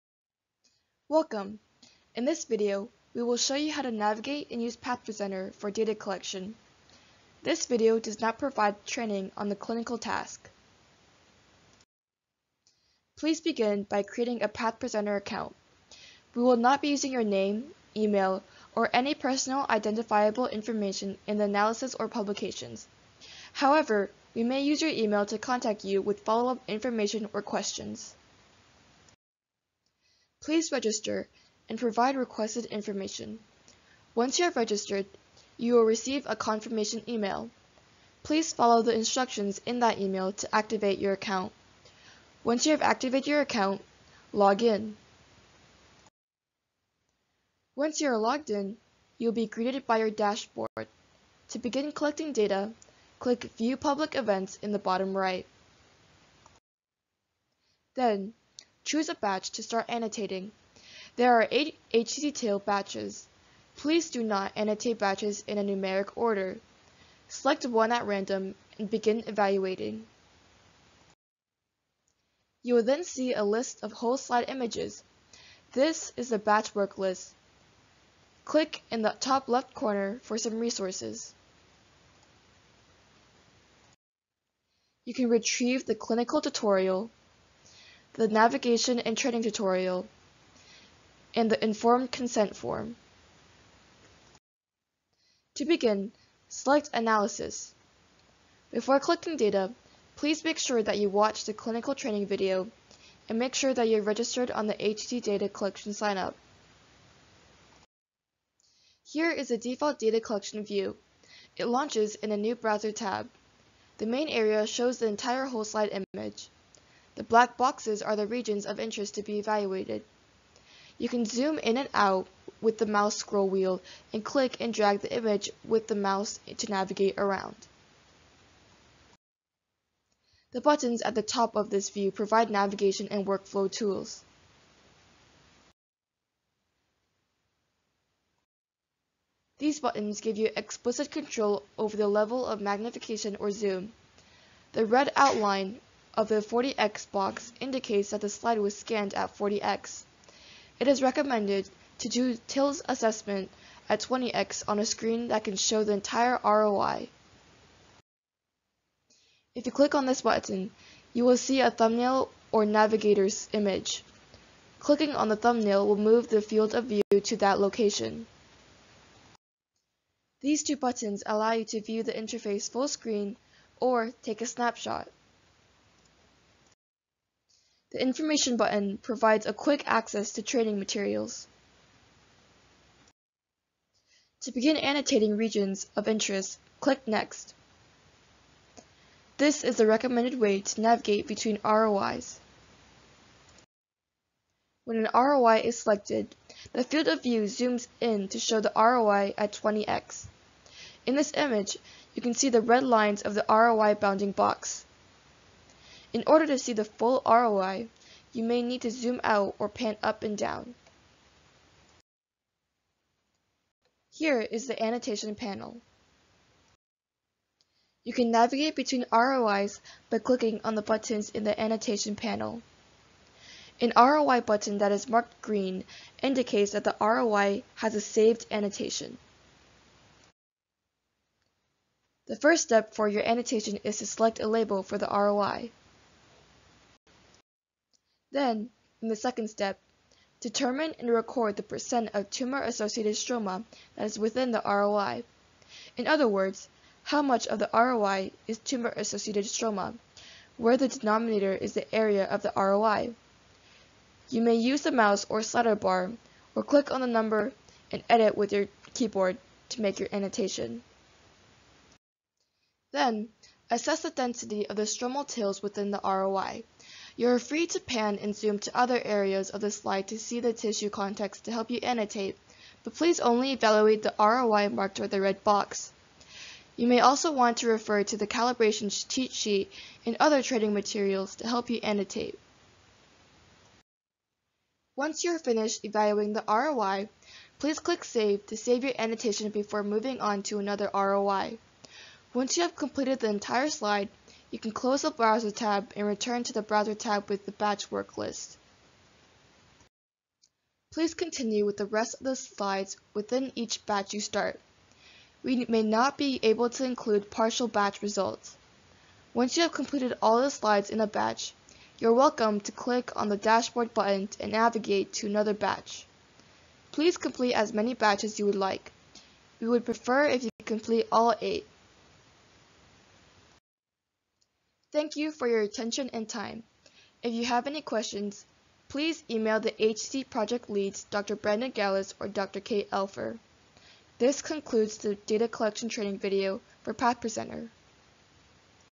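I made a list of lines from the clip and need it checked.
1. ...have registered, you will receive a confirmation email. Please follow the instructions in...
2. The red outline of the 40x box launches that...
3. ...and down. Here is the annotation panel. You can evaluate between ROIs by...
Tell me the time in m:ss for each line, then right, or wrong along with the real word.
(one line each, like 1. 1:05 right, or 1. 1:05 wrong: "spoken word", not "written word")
1. 0:34 right
2. 2:24 wrong: "indicates", not "launches"
3. 3:30 wrong: "navigate", not "evaluate".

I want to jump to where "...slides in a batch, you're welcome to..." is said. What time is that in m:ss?
5:10.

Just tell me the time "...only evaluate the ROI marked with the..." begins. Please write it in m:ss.
4:33.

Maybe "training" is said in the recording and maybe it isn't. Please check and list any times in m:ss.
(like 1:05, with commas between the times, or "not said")
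0:08, 1:29, 1:41, 3:00, 4:40, 5:35.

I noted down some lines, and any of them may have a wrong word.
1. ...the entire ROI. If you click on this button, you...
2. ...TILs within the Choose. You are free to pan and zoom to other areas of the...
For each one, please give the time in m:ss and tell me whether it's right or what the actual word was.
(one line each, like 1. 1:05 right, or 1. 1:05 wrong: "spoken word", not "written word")
1. 2:35 right
2. 4:25 wrong: "ROI", not "Choose".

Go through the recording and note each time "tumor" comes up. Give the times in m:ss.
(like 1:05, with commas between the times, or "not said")
4:02, 4:08.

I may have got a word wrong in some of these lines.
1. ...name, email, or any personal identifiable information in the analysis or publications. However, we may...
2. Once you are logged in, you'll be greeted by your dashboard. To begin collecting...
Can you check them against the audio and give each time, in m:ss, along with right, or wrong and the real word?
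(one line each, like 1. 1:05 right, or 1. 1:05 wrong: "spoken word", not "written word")
1. 0:17 right
2. 0:47 right.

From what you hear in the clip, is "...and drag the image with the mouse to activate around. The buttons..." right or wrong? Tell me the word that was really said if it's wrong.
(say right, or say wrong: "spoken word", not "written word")
wrong: "navigate", not "activate".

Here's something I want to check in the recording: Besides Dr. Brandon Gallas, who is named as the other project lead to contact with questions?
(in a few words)
Dr. Kate Elfer.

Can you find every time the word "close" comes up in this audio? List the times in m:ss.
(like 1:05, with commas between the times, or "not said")
4:54.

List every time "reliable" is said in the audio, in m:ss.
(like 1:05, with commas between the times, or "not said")
not said.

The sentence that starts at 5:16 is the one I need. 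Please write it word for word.
Please complete as many batches you would like.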